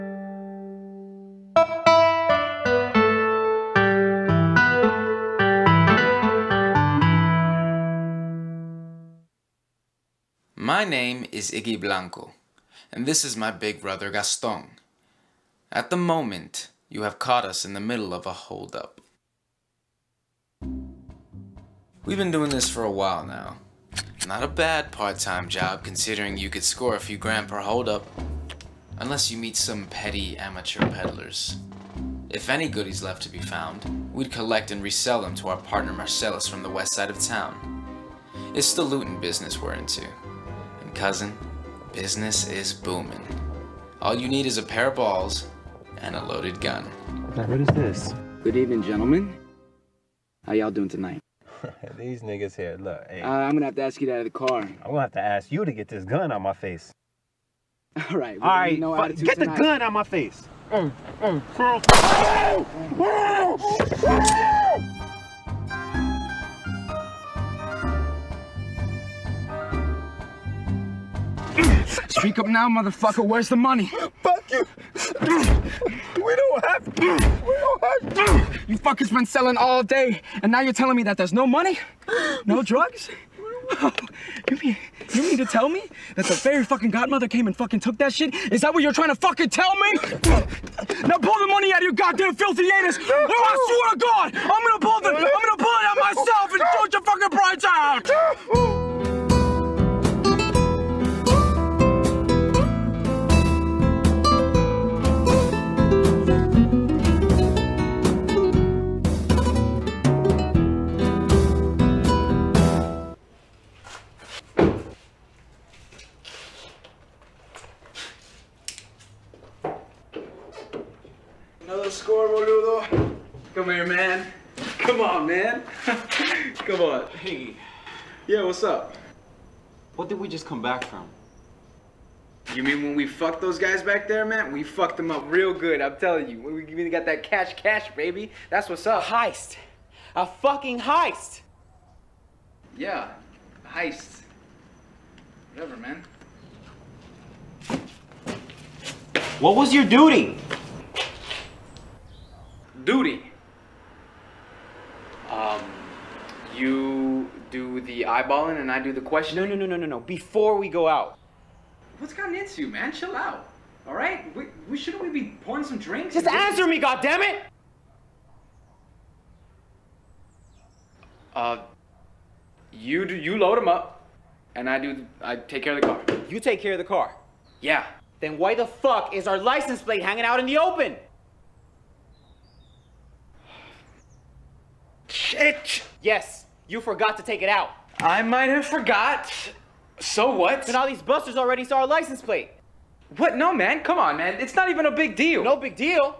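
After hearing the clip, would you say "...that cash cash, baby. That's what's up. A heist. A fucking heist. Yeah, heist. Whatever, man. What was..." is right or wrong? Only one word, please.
right.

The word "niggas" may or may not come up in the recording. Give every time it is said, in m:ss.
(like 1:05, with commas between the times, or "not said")
0:52.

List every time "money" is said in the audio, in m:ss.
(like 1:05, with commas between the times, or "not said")
1:13, 1:21, 1:31.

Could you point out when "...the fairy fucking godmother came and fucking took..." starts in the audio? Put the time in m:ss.
1:26.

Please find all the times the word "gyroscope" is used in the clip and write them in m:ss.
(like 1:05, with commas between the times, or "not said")
not said.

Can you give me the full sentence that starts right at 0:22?
We've been doing this for a while now.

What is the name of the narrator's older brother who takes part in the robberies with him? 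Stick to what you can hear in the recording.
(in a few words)
Gaston.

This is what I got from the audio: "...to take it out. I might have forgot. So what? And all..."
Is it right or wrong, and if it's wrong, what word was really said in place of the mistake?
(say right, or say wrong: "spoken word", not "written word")
right.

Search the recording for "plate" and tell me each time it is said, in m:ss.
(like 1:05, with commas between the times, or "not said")
2:59, 3:12.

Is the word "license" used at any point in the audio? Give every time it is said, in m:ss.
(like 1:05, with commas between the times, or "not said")
2:59, 3:11.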